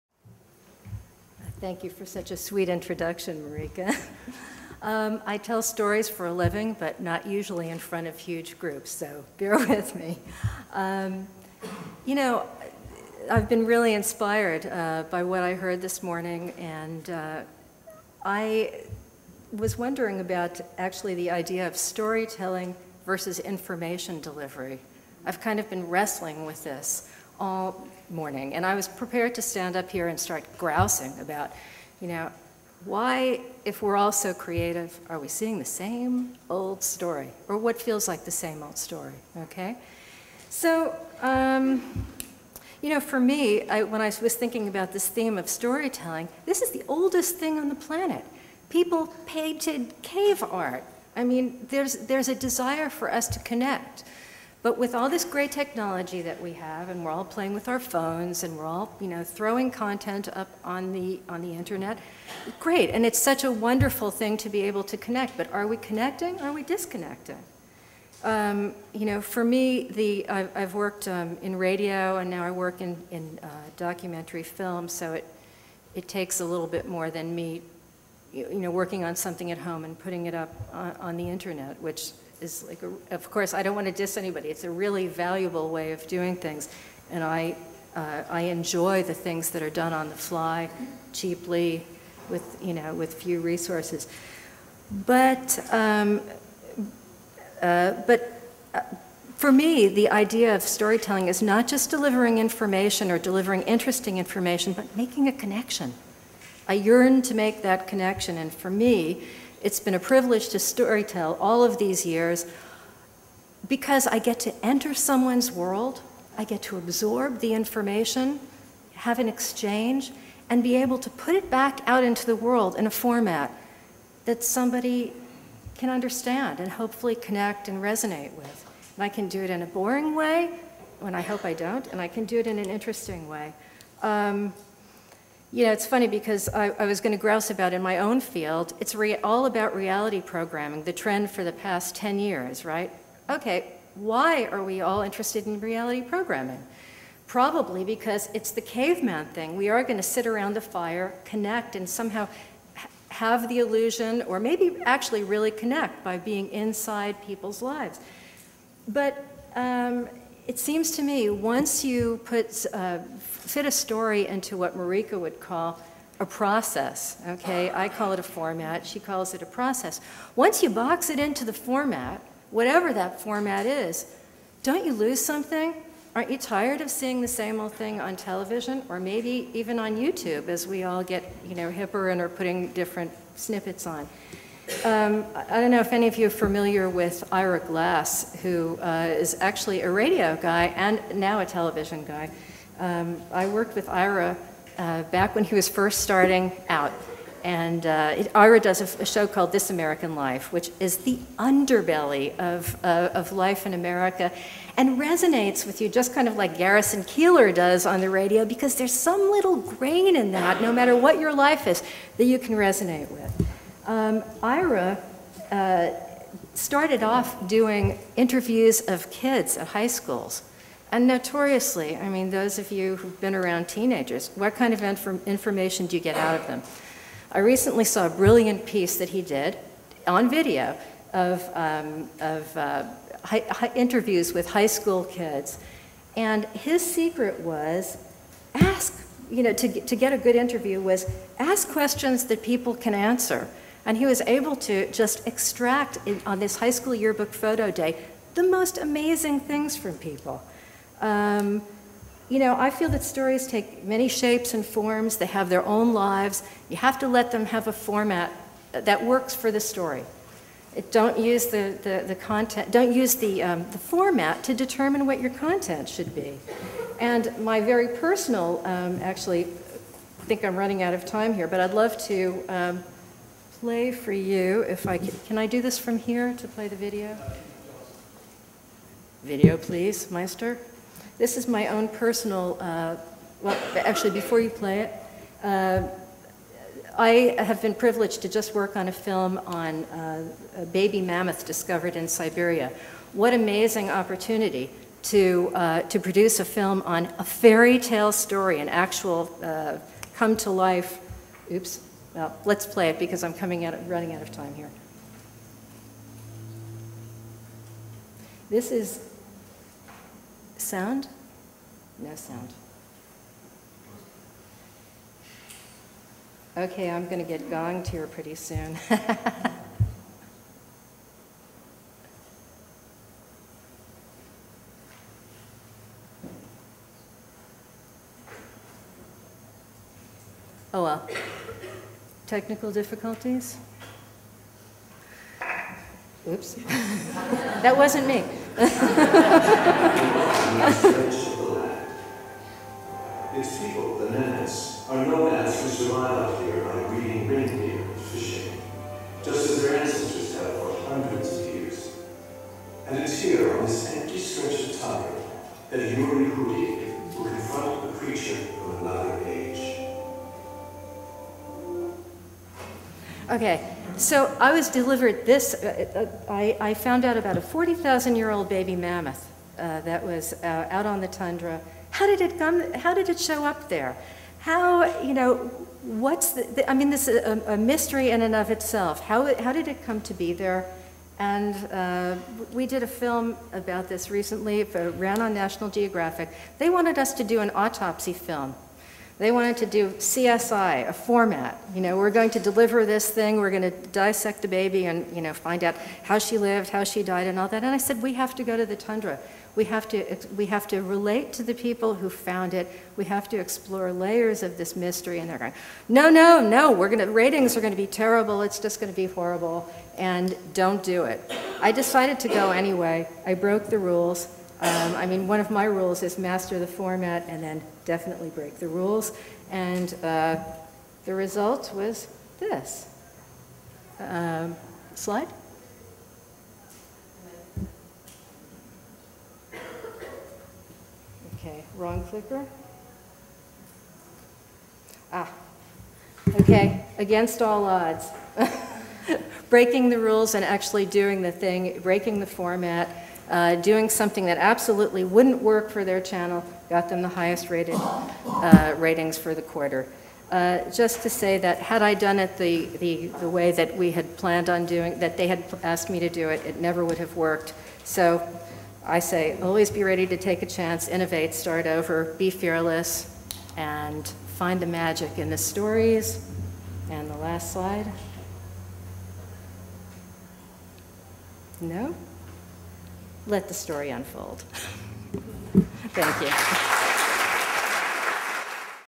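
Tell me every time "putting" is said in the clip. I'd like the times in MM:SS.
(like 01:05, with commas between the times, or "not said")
01:19, 03:02.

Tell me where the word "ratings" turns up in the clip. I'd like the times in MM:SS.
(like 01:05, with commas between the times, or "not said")
06:47, 07:28.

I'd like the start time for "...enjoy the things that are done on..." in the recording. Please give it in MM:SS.
01:28.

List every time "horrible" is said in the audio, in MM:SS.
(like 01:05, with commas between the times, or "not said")
06:49.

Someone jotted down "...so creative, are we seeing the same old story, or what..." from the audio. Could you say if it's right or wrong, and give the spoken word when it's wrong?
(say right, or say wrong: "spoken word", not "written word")
right.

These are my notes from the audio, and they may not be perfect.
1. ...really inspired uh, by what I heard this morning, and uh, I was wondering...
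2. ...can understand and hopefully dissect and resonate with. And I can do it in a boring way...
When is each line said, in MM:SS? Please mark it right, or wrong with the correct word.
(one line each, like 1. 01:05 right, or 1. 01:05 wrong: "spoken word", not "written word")
1. 00:13 right
2. 02:05 wrong: "connect", not "dissect".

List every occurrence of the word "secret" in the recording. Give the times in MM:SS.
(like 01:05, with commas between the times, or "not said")
03:56.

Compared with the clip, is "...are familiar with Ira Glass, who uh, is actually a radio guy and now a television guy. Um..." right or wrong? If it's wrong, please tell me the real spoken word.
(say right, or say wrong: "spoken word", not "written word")
right.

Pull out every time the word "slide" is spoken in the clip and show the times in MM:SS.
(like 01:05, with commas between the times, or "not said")
07:04, 07:47.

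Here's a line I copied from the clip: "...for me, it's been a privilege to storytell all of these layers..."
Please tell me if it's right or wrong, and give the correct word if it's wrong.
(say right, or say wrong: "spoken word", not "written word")
wrong: "years", not "layers".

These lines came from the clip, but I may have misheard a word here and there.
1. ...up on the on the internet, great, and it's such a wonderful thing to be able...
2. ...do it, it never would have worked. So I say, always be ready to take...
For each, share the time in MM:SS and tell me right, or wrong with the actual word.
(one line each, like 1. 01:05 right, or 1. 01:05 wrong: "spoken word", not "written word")
1. 01:00 right
2. 07:36 right.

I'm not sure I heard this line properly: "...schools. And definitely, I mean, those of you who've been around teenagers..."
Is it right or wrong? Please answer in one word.
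wrong.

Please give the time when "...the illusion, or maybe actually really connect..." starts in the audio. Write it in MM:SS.
02:33.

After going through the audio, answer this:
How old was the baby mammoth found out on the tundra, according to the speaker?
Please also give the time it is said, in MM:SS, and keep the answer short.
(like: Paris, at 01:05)
40,000 years, at 06:07.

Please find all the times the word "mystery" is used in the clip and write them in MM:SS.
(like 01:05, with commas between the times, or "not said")
06:17, 06:44.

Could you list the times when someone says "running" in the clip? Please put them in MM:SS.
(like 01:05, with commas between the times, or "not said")
04:30, 05:03.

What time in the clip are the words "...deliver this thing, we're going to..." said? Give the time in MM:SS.
06:32.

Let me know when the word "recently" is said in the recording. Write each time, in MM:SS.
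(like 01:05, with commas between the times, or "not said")
03:47, 06:24.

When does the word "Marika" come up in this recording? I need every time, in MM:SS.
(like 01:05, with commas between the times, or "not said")
00:03, 02:44.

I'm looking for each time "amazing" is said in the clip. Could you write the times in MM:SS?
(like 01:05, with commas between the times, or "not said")
04:08, 04:53.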